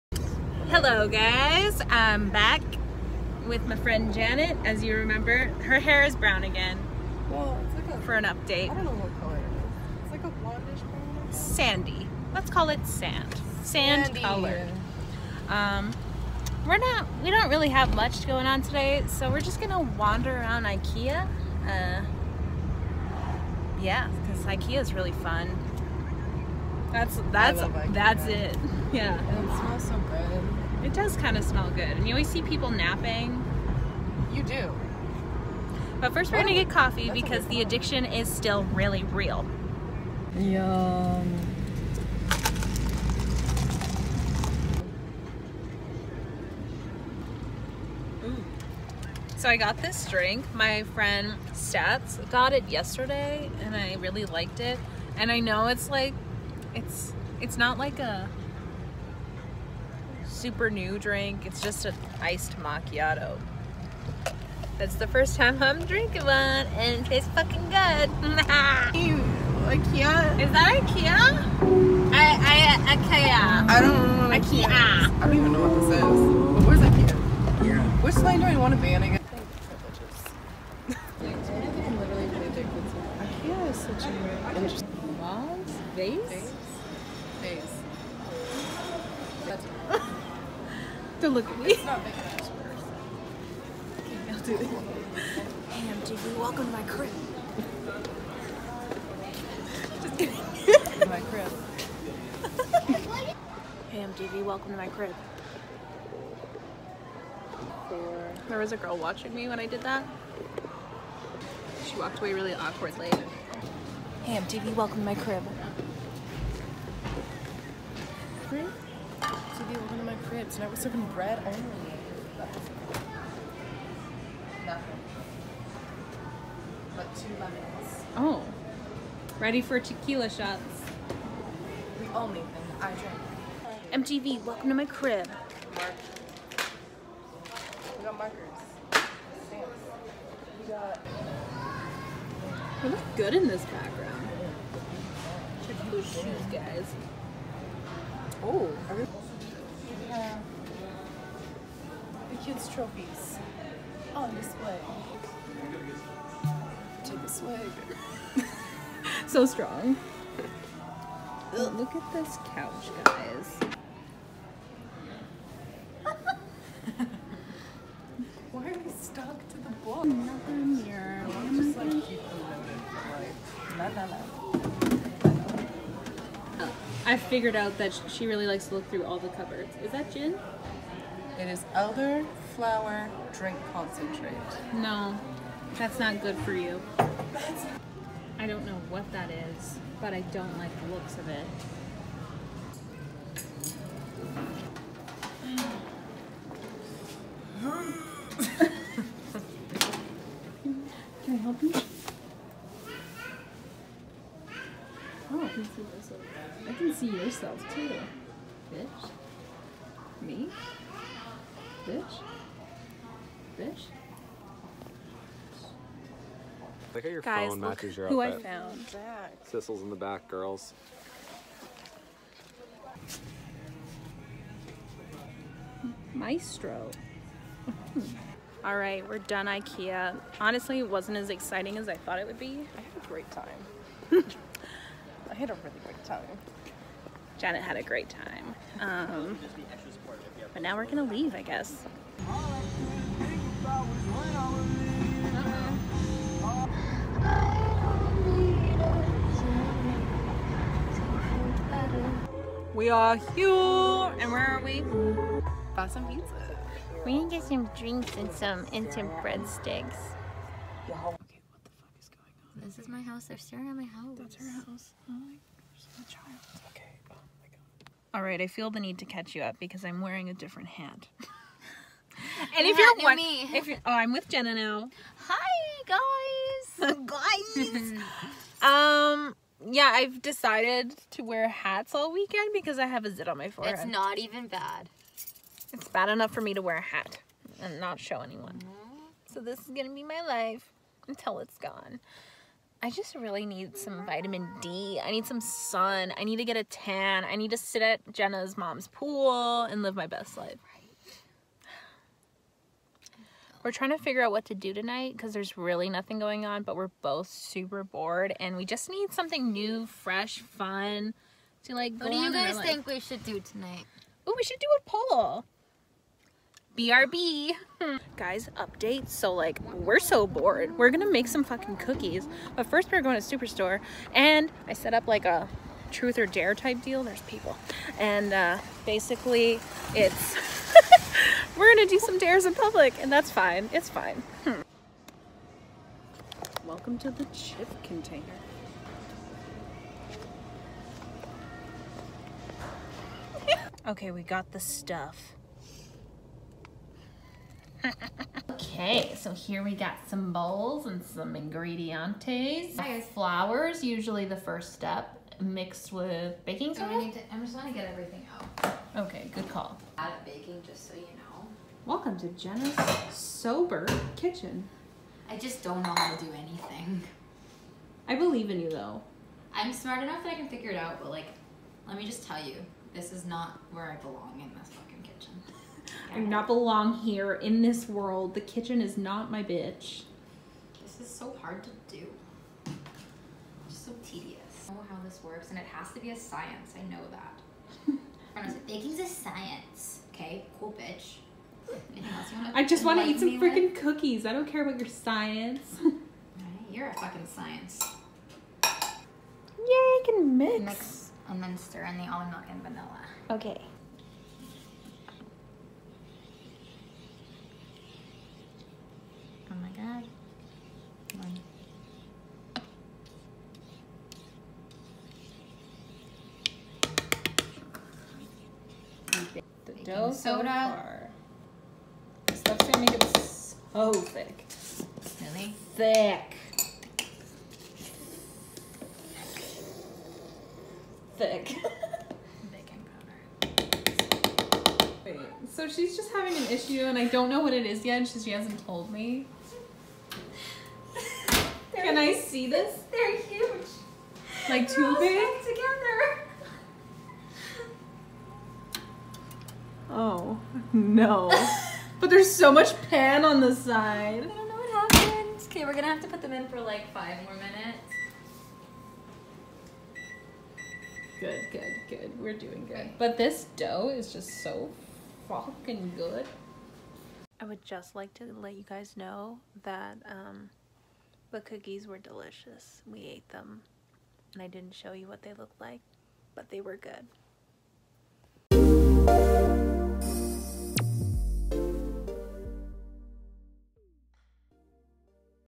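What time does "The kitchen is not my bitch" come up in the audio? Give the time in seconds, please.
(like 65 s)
378 s.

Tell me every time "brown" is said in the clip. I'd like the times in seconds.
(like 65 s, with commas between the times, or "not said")
6 s, 10 s.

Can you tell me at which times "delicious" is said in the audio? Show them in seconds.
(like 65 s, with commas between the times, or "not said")
471 s.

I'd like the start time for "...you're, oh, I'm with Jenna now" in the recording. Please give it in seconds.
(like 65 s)
273 s.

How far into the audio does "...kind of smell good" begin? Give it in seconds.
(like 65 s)
31 s.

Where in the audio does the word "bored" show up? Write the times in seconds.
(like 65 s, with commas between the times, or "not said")
307 s, 320 s.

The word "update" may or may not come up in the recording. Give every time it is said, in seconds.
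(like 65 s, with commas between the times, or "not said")
8 s, 318 s.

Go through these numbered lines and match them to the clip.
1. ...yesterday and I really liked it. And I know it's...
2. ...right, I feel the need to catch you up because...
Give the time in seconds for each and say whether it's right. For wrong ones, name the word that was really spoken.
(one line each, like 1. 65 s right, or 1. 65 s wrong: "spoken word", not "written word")
1. 52 s right
2. 268 s right.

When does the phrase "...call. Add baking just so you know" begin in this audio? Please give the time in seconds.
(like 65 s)
359 s.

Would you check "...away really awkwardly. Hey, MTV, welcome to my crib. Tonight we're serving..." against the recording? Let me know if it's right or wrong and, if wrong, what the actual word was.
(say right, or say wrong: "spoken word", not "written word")
right.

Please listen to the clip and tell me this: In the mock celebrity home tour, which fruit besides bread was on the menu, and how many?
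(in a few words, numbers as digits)
2 lemons.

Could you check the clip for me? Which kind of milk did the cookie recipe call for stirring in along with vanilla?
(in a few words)
Almond milk.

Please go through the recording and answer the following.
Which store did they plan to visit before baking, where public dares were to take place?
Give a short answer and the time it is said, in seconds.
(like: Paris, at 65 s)
Superstore, at 323 s.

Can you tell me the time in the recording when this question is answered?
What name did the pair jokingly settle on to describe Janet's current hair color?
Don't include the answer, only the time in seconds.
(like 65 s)
12 s.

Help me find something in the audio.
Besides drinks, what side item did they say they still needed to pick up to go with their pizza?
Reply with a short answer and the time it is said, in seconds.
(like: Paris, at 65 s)
Breadsticks, at 259 s.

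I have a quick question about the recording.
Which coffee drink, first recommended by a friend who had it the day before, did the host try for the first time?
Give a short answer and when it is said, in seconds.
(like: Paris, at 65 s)
Iced macchiato, at 62 s.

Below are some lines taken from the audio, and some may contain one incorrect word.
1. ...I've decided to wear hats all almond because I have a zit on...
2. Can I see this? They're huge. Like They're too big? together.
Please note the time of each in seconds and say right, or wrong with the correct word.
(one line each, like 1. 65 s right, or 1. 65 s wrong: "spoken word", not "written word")
1. 279 s wrong: "weekend", not "almond"
2. 441 s right.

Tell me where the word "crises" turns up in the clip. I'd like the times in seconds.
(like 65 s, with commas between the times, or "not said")
not said.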